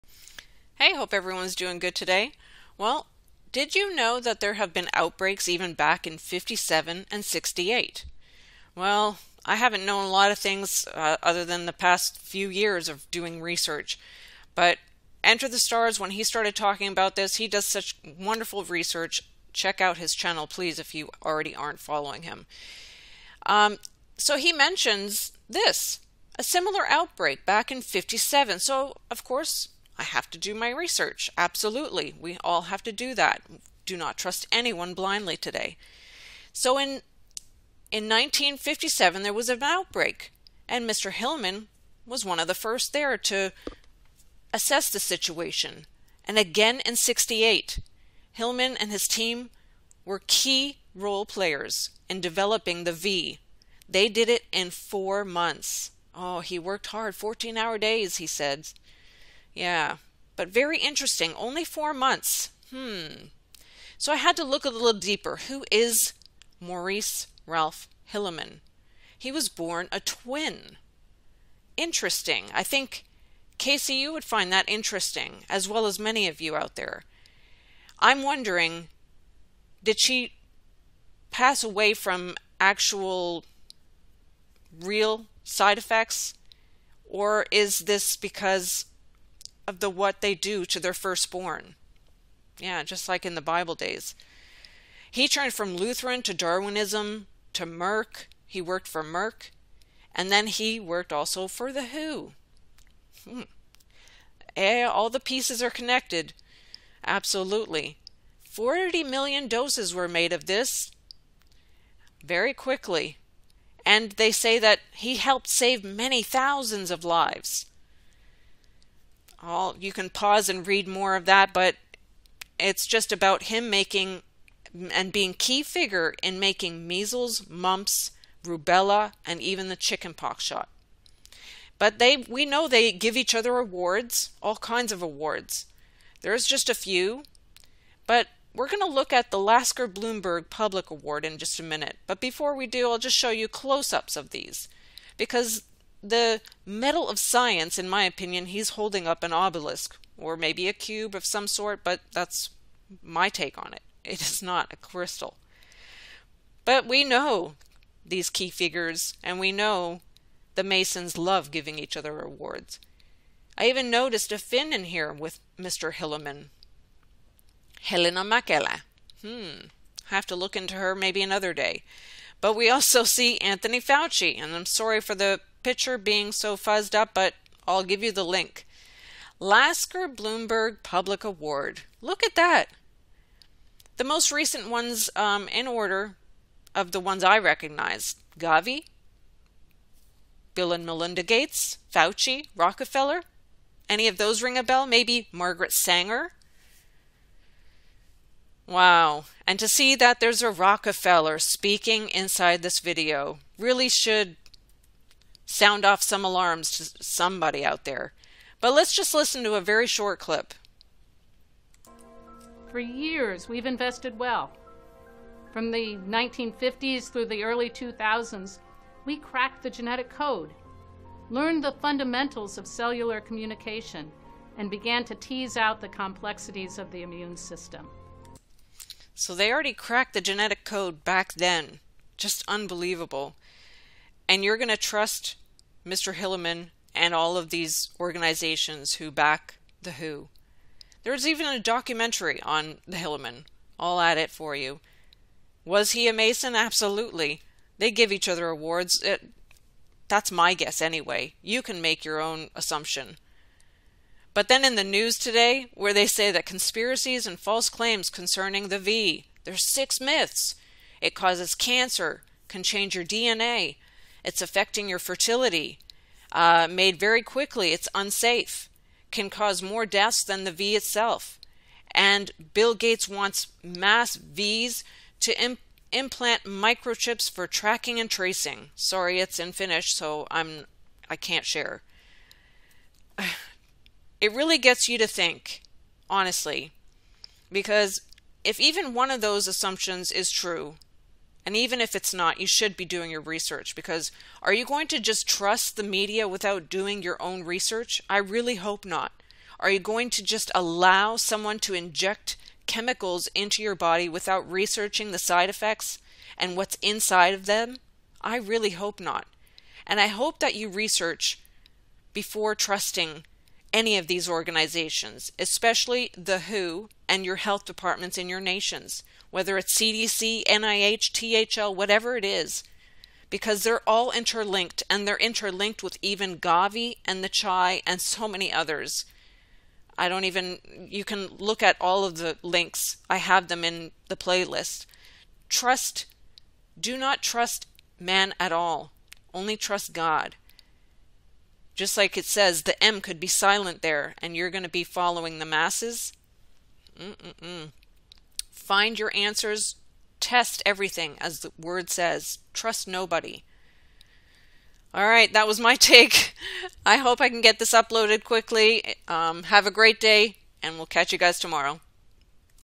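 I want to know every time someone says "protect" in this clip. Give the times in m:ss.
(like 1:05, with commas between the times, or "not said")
not said.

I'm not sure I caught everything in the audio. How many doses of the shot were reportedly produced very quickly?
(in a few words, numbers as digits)
40 million.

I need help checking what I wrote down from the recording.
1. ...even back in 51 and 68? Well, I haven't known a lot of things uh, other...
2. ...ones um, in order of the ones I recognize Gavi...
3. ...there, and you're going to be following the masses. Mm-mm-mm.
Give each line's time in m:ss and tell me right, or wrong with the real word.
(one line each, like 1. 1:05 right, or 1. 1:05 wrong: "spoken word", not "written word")
1. 0:05 wrong: "57", not "51"
2. 3:04 right
3. 5:43 right.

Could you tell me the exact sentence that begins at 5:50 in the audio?
Test everything, as the word says.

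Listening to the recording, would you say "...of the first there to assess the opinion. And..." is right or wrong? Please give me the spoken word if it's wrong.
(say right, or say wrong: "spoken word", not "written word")
wrong: "situation", not "opinion".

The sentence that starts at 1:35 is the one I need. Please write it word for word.
He turned from Lutheran to Darwinism to Merck.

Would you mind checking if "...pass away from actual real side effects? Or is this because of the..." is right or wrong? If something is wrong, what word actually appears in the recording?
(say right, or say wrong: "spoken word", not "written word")
right.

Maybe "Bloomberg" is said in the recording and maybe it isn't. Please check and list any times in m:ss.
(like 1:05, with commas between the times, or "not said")
2:19, 3:00.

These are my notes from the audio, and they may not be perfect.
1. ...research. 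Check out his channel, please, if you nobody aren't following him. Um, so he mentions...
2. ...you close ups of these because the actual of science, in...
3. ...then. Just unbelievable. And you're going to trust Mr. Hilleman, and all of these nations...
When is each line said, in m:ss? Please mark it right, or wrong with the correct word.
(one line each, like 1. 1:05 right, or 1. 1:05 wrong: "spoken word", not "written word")
1. 0:18 wrong: "already", not "nobody"
2. 2:23 wrong: "medal", not "actual"
3. 3:51 wrong: "organizations", not "nations".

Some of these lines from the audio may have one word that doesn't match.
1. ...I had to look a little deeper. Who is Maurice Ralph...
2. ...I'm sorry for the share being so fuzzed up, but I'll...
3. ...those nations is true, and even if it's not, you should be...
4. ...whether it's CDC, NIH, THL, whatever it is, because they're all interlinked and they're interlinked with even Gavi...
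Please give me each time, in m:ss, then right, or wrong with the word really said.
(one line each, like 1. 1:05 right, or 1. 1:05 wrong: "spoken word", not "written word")
1. 1:04 right
2. 2:54 wrong: "picture", not "share"
3. 4:49 wrong: "assumptions", not "nations"
4. 5:19 right.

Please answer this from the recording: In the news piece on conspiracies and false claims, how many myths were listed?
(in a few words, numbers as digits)
6.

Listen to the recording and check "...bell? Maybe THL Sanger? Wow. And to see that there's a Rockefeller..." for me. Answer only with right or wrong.
wrong.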